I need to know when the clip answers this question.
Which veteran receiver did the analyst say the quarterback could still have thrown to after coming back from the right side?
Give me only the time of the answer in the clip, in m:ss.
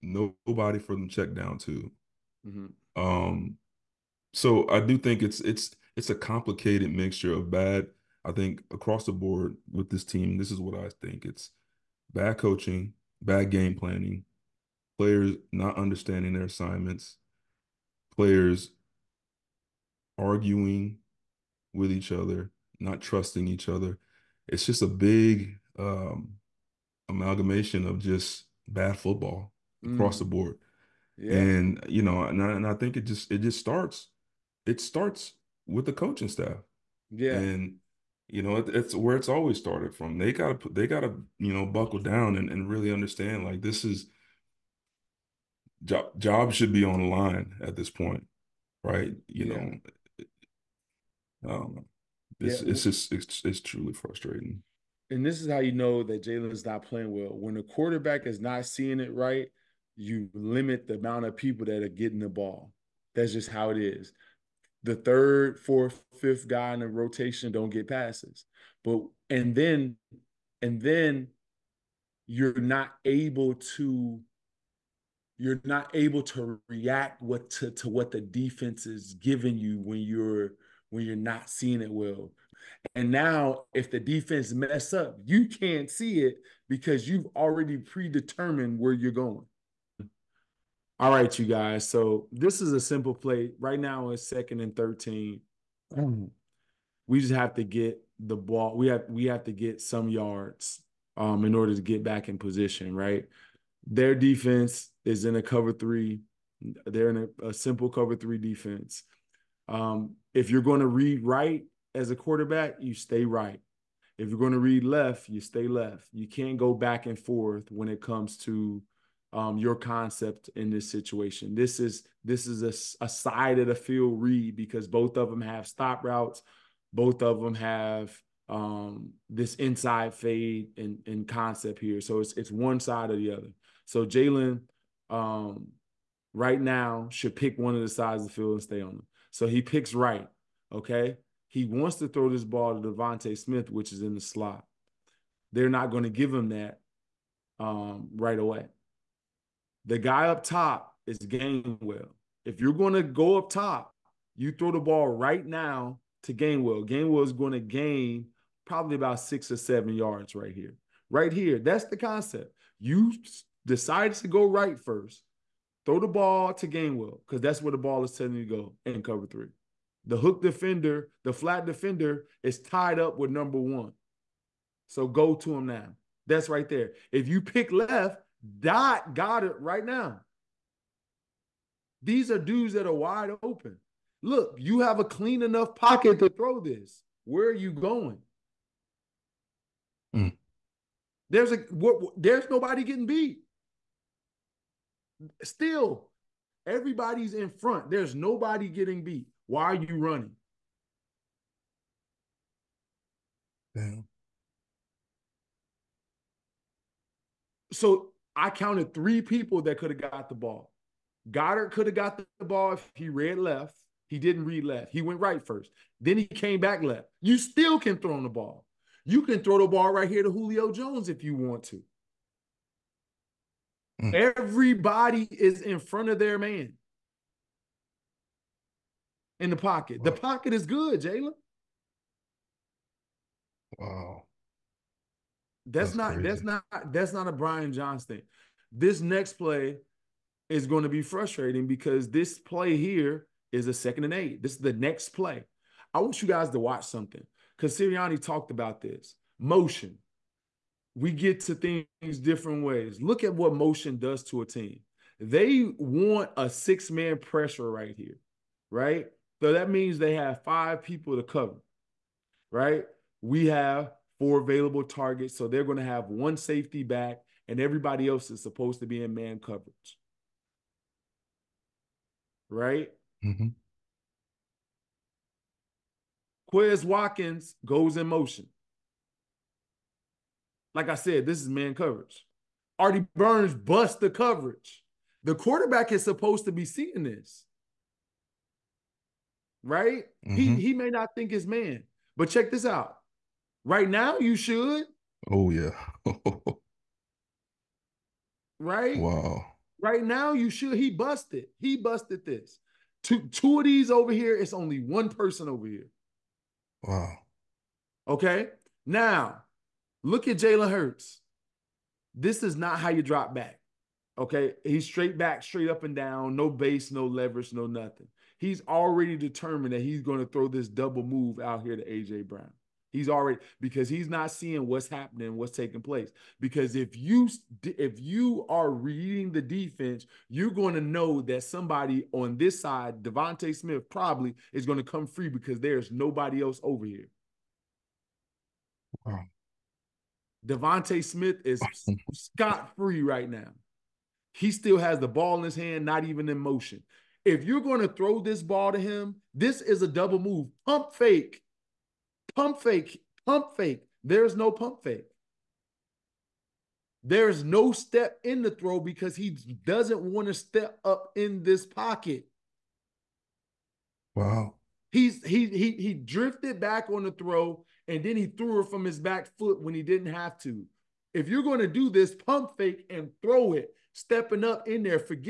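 3:40.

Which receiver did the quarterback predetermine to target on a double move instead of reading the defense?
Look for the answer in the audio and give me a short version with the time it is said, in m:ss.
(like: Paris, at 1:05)
AJ Brown, at 5:21.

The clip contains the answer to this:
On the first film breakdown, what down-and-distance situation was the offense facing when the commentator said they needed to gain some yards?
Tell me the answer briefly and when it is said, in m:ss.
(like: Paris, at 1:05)
Second and 13, at 1:34.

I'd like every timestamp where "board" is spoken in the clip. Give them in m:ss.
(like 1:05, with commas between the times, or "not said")
0:09, 0:30.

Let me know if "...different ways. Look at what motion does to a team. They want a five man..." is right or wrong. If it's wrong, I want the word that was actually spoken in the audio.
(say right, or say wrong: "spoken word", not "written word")
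wrong: "six", not "five".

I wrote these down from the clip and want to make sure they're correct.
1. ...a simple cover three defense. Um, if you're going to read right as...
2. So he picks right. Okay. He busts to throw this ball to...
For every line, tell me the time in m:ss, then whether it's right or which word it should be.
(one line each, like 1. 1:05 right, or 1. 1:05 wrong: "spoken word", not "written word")
1. 1:47 right
2. 2:19 wrong: "wants", not "busts".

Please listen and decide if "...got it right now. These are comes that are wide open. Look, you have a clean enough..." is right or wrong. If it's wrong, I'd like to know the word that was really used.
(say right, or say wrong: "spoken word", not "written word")
wrong: "dudes", not "comes".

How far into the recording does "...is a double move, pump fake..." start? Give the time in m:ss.
5:49.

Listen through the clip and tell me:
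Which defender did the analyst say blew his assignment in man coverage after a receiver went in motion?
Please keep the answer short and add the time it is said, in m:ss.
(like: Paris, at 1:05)
Artie Burns, at 4:42.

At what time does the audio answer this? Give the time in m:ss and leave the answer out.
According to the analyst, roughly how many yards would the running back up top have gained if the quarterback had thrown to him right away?
2:39.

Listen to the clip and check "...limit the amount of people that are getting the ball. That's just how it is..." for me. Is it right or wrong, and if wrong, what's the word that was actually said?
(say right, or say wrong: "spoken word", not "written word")
right.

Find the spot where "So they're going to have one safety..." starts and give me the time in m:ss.
4:25.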